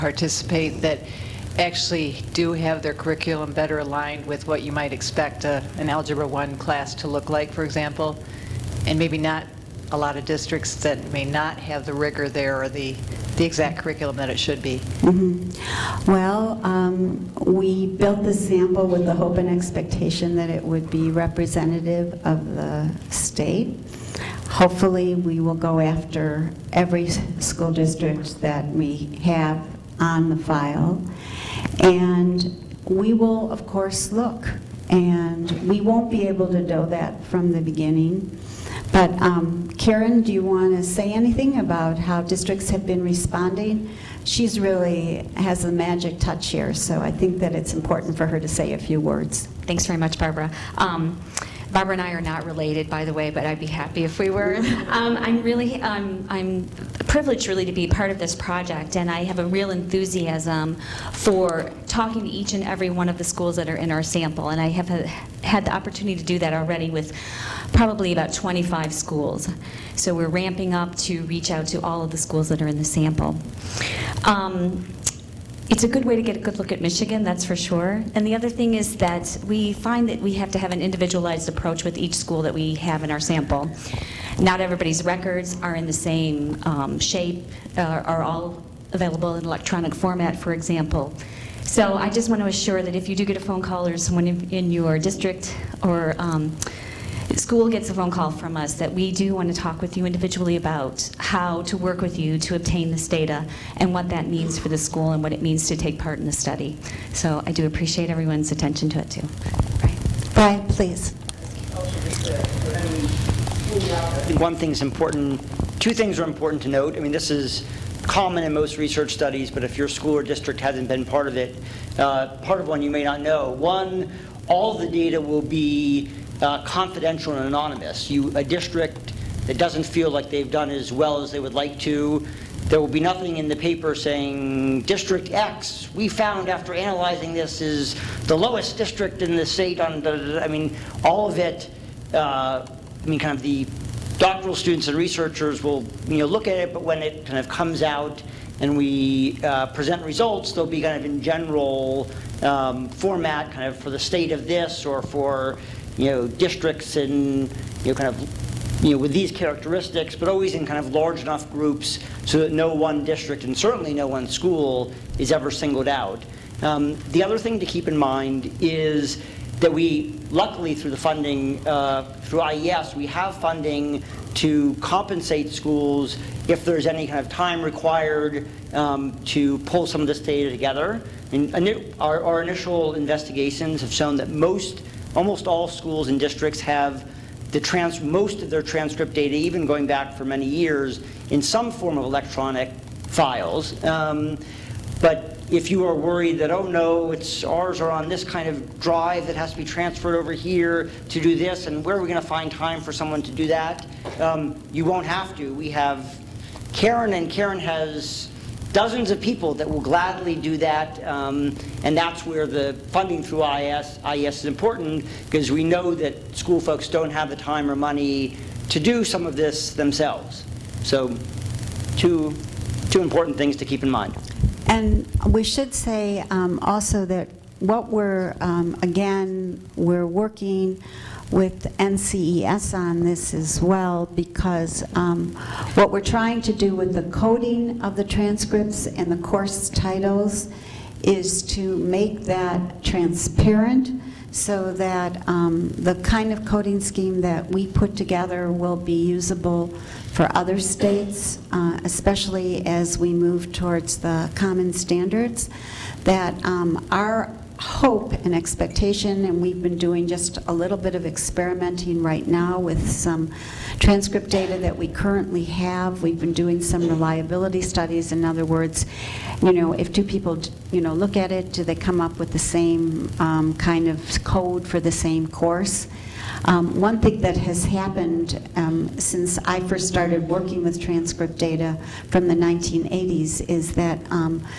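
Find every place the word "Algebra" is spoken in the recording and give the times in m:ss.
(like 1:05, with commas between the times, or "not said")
0:05.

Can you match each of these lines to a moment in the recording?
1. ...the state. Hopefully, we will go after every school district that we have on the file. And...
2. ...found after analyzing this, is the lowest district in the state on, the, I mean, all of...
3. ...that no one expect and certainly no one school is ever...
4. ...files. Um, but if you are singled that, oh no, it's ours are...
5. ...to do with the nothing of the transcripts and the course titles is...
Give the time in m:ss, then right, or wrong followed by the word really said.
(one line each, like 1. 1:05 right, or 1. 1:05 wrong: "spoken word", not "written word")
1. 0:22 right
2. 2:16 right
3. 2:42 wrong: "district", not "expect"
4. 3:13 wrong: "worried", not "singled"
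5. 3:56 wrong: "coding", not "nothing".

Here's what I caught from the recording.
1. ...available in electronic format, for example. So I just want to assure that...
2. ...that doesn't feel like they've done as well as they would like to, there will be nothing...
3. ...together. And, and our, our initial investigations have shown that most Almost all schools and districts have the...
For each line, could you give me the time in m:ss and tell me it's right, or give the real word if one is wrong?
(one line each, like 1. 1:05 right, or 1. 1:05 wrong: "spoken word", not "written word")
1. 1:28 right
2. 2:09 right
3. 3:00 right.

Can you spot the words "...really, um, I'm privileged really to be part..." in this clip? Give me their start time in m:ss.
0:55.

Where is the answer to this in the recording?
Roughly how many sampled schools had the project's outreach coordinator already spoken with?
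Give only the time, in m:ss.
1:08.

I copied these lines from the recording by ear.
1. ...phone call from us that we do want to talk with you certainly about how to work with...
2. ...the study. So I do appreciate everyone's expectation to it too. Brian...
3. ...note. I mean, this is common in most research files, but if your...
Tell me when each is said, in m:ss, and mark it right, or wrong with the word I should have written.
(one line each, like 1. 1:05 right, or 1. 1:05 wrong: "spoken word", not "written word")
1. 1:37 wrong: "individually", not "certainly"
2. 1:46 wrong: "attention", not "expectation"
3. 1:56 wrong: "studies", not "files".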